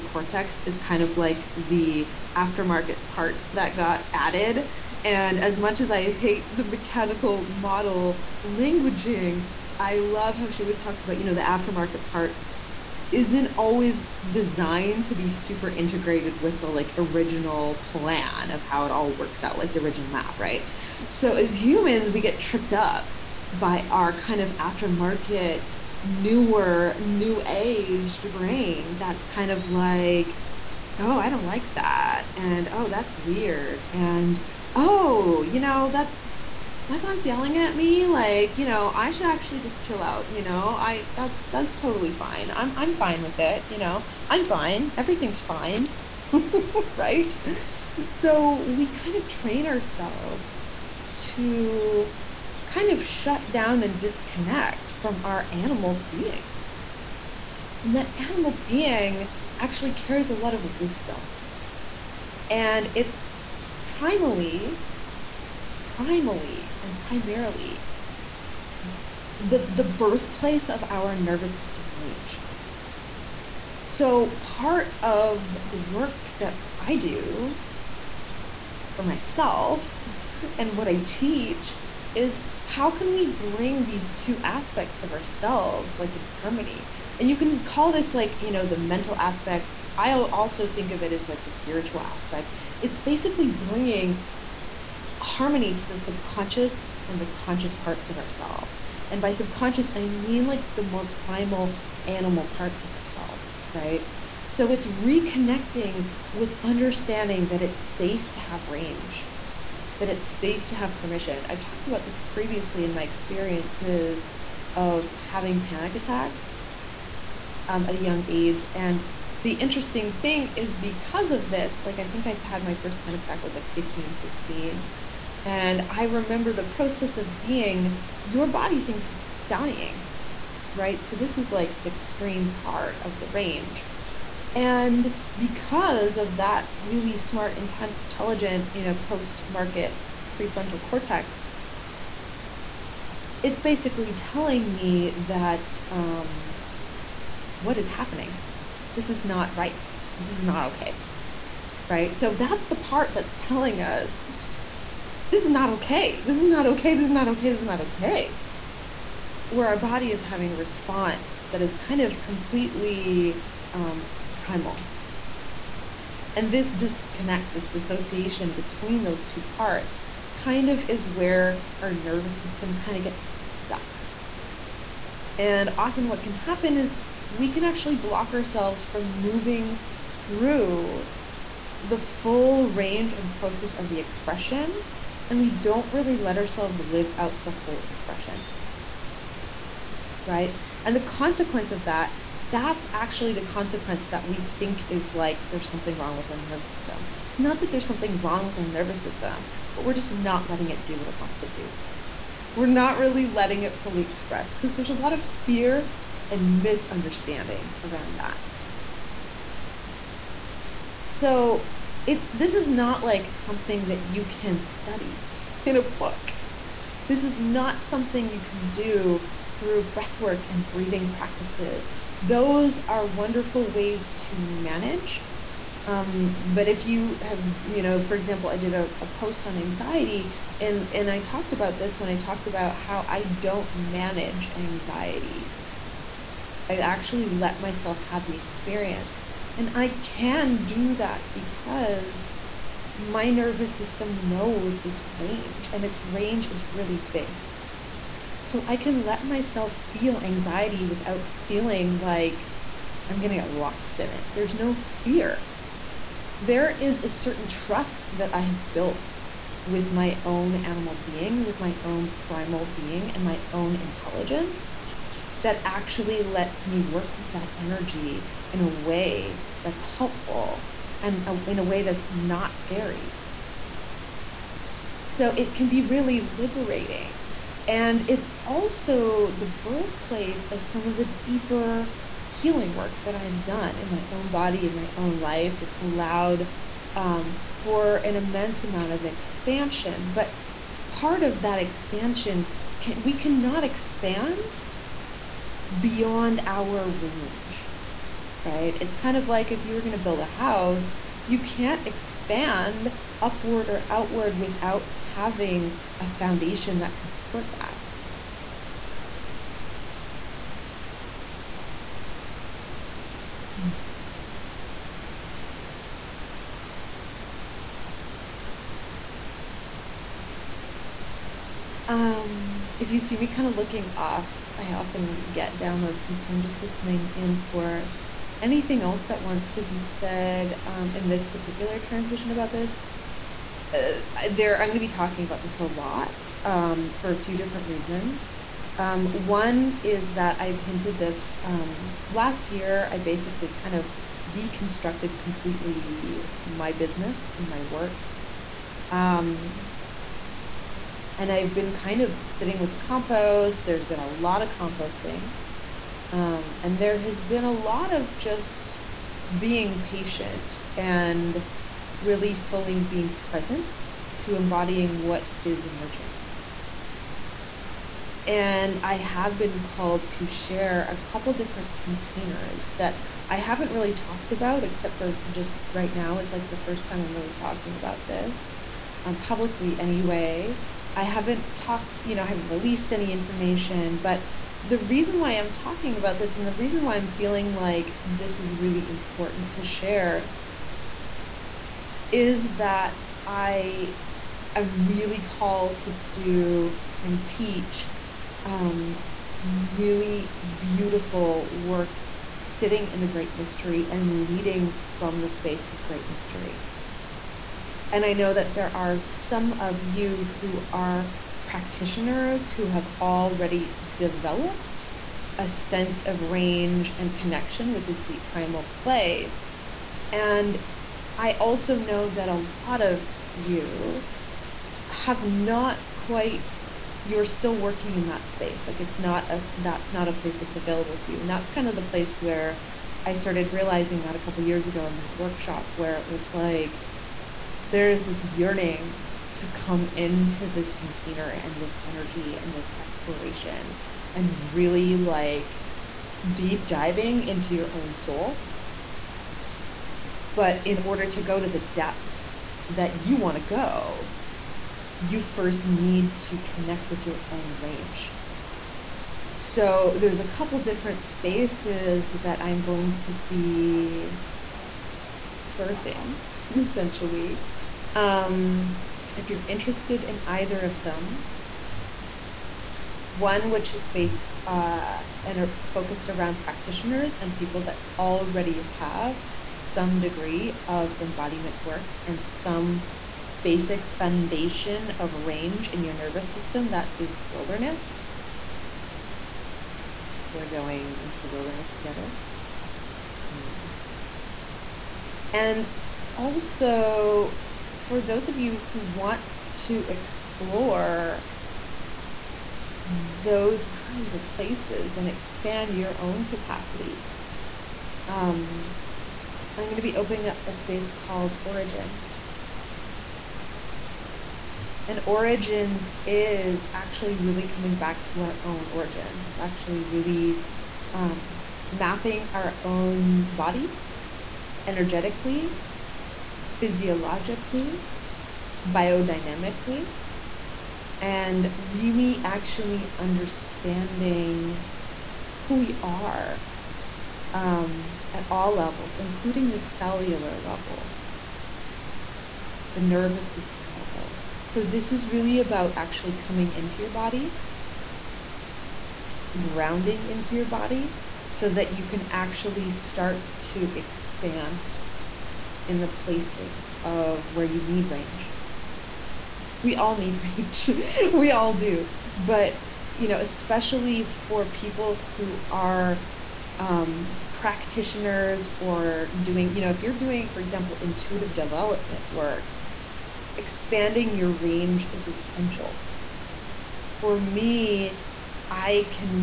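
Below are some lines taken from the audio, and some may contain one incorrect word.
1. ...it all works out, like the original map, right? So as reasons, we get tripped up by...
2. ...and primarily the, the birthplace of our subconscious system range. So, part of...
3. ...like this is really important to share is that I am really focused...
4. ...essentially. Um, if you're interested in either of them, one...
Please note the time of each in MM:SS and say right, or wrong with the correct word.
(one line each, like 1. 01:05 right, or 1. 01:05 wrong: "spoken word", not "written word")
1. 00:18 wrong: "humans", not "reasons"
2. 01:06 wrong: "nervous", not "subconscious"
3. 06:27 wrong: "called", not "focused"
4. 07:46 right.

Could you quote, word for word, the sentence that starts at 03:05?
And we don't really let ourselves live out the whole expression.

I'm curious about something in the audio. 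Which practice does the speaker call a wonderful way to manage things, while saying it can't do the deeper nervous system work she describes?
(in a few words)
breathwork.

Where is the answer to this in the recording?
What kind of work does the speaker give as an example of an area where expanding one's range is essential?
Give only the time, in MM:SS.
09:30.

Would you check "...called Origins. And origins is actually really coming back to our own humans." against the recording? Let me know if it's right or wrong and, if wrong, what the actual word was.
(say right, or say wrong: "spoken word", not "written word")
wrong: "origins", not "humans".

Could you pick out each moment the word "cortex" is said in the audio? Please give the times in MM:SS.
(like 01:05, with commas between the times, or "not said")
00:00, 02:20.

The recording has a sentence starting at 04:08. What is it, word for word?
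So I can let myself feel anxiety without feeling like I'm going to get lost in it.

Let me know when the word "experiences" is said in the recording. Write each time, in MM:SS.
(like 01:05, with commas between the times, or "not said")
01:53, 03:58.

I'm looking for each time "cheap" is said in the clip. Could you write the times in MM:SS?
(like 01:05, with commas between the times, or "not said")
not said.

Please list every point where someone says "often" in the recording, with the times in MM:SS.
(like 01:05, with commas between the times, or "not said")
02:55, 05:24.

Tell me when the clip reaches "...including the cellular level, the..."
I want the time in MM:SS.
08:58.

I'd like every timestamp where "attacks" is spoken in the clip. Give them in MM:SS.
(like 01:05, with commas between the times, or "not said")
01:55, 02:03.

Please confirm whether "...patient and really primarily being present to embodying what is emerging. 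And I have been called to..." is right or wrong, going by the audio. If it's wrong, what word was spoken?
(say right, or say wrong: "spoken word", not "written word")
wrong: "fully", not "primarily".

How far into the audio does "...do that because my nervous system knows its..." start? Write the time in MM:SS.
04:00.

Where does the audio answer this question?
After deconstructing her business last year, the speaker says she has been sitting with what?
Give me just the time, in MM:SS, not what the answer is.
05:52.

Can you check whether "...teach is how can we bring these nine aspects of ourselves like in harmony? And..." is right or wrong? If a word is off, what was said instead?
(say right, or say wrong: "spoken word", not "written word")
wrong: "two", not "nine".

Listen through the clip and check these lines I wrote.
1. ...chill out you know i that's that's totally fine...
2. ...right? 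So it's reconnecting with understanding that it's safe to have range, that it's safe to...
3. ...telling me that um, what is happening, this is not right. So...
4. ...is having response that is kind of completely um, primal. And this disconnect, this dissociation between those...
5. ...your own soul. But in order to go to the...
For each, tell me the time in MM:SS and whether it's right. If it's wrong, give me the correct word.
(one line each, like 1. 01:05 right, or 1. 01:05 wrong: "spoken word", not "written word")
1. 00:39 right
2. 01:43 right
3. 02:24 right
4. 02:40 right
5. 07:27 right.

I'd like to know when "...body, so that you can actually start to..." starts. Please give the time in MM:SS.
09:10.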